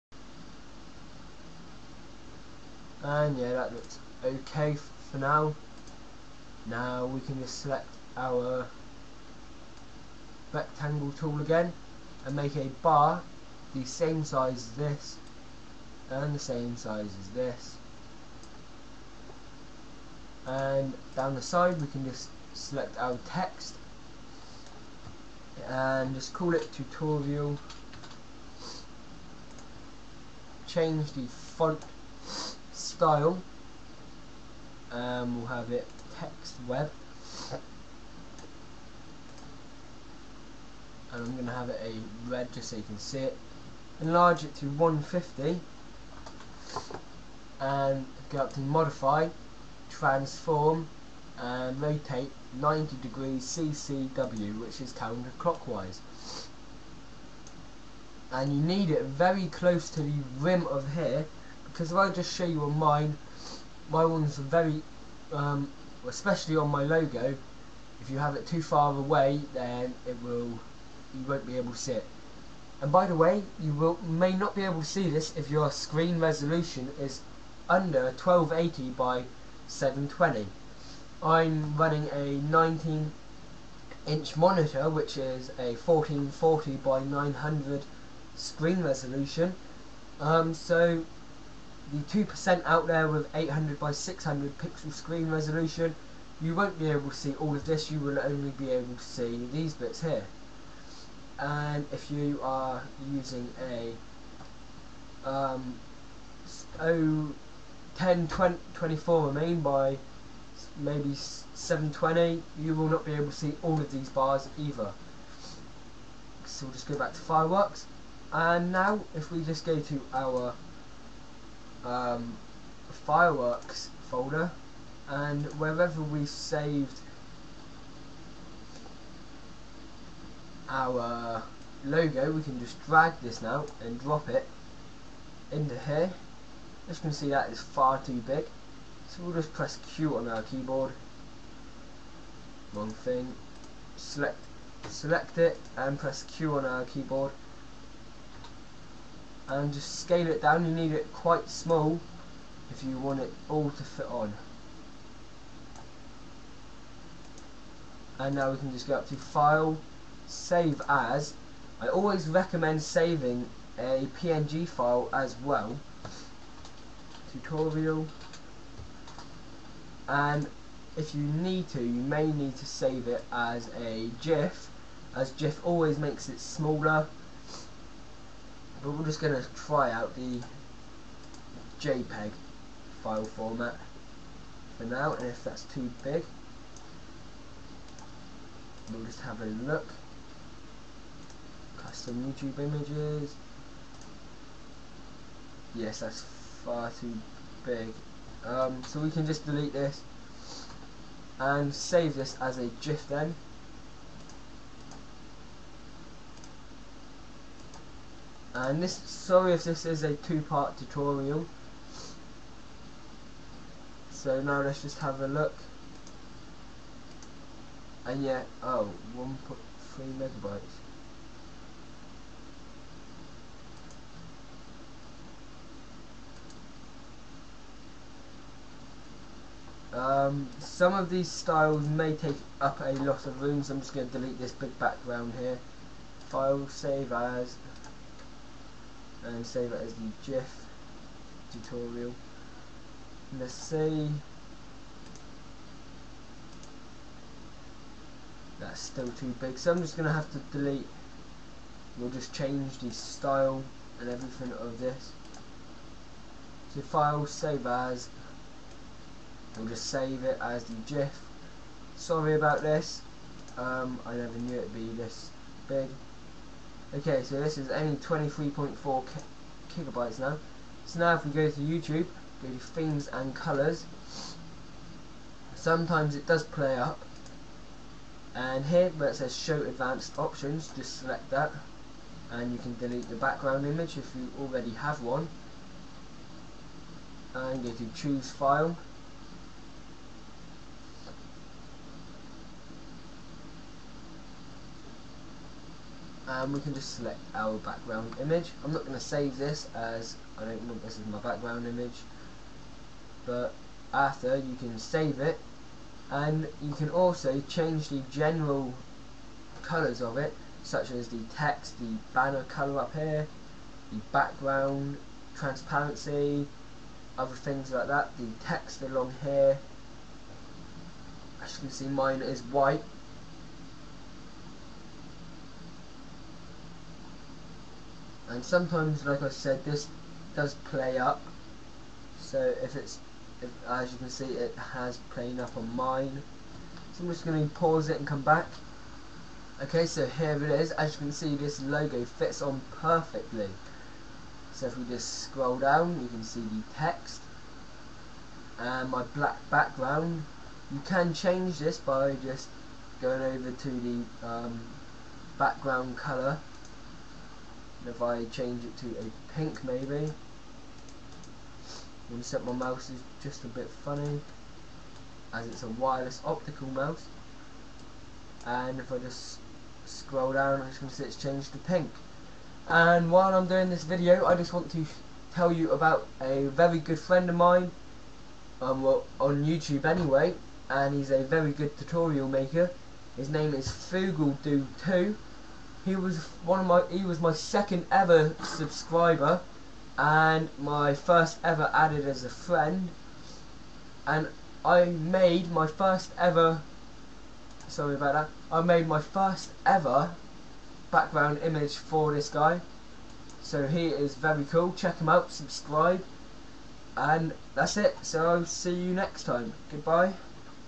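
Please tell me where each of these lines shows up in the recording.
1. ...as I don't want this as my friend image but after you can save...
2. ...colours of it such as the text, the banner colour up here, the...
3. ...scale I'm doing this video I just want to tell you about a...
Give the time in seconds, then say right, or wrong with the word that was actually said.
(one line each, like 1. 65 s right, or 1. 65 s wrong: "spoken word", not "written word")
1. 299 s wrong: "background", not "friend"
2. 309 s right
3. 373 s wrong: "while", not "scale".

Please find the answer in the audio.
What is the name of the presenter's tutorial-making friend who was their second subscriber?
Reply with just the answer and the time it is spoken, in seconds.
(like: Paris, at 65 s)
Fugal Do 2, at 383 s.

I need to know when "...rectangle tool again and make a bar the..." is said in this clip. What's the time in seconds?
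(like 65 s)
10 s.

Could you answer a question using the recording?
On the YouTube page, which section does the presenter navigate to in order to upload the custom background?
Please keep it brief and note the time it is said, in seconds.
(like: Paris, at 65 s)
themes and colours, at 272 s.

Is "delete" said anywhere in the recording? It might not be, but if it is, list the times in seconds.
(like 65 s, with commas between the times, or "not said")
199 s, 234 s, 250 s, 282 s.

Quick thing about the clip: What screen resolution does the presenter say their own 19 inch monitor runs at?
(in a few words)
1440 by 900.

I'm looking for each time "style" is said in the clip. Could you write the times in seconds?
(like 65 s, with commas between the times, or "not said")
33 s, 231 s, 252 s.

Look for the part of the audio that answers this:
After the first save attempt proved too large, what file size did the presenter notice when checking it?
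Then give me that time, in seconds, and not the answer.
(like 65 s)
219 s.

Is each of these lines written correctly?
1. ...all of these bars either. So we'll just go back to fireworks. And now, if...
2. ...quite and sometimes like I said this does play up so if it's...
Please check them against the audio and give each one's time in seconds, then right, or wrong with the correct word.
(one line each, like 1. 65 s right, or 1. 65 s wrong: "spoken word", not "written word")
1. 113 s right
2. 322 s wrong: "white", not "quite".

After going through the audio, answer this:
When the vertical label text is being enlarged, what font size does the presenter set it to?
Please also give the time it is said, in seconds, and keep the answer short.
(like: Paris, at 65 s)
150, at 44 s.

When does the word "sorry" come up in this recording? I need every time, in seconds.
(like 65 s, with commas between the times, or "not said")
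208 s, 261 s, 397 s.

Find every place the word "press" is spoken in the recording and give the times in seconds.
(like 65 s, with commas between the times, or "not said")
139 s, 145 s.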